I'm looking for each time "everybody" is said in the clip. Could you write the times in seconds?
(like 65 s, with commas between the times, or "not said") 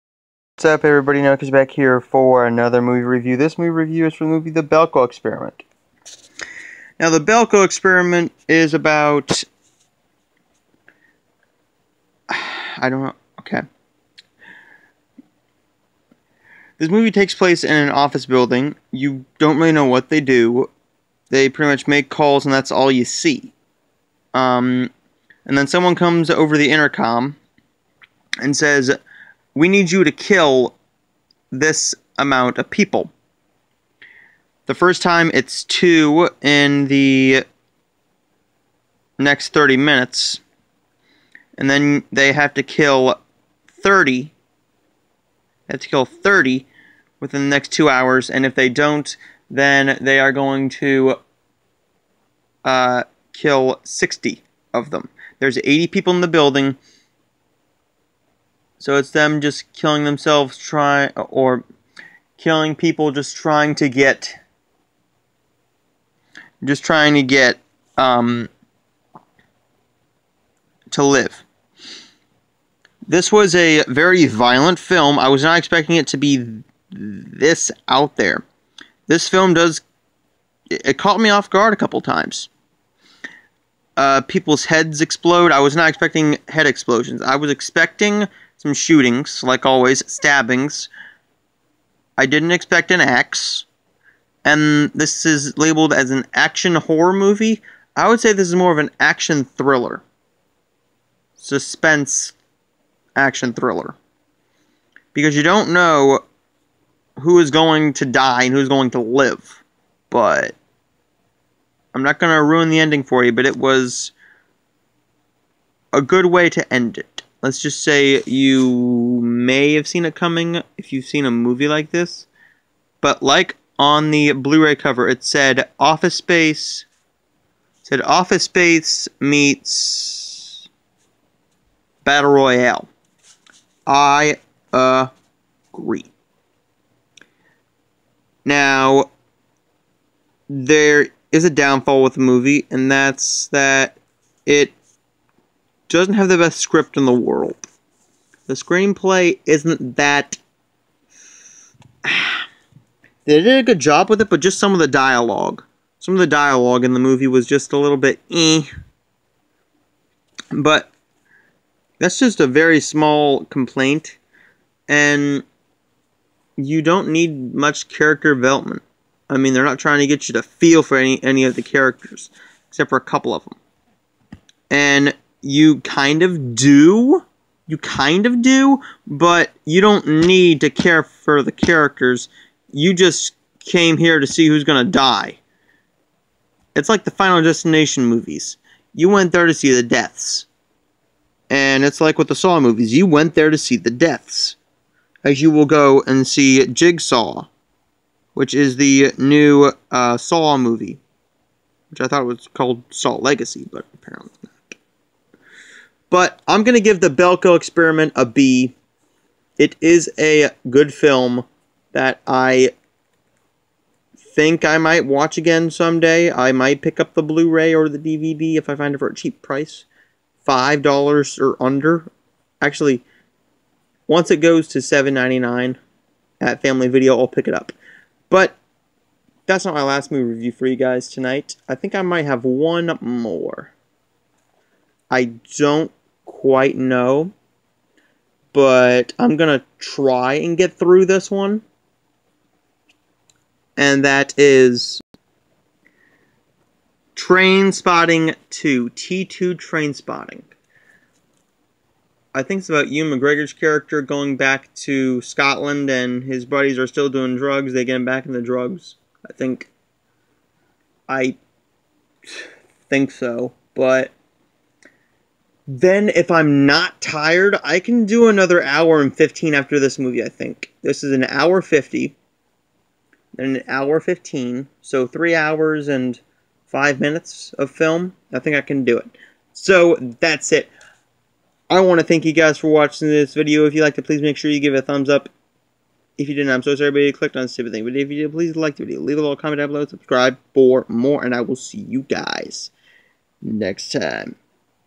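0 s, 286 s.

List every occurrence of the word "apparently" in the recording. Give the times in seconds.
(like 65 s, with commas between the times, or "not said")
203 s.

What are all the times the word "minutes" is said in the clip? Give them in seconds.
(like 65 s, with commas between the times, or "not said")
39 s, 276 s.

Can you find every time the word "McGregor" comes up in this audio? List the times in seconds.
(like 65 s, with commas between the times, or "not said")
253 s.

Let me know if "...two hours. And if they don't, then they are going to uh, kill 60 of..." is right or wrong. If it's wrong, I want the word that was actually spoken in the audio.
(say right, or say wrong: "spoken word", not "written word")
right.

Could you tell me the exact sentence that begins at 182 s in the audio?
You just came here to see who's going to die.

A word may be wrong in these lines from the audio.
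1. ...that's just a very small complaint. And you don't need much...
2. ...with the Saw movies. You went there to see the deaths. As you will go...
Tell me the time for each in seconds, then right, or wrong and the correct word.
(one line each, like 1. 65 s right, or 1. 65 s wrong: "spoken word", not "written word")
1. 161 s right
2. 192 s right.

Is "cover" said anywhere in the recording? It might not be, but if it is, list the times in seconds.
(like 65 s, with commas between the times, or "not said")
124 s.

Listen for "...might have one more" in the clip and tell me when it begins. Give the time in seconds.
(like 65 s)
232 s.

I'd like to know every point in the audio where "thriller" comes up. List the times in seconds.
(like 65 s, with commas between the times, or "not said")
99 s, 103 s.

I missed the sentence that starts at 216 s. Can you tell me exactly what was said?
I might pick up the Blu-ray or the DVD if I find it for a cheap price.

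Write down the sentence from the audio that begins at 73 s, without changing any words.
This was a very violent film.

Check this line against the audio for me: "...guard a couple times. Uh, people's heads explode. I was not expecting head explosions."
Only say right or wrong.
right.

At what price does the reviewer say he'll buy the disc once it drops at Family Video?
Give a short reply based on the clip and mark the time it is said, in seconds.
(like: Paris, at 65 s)
$7.99, at 224 s.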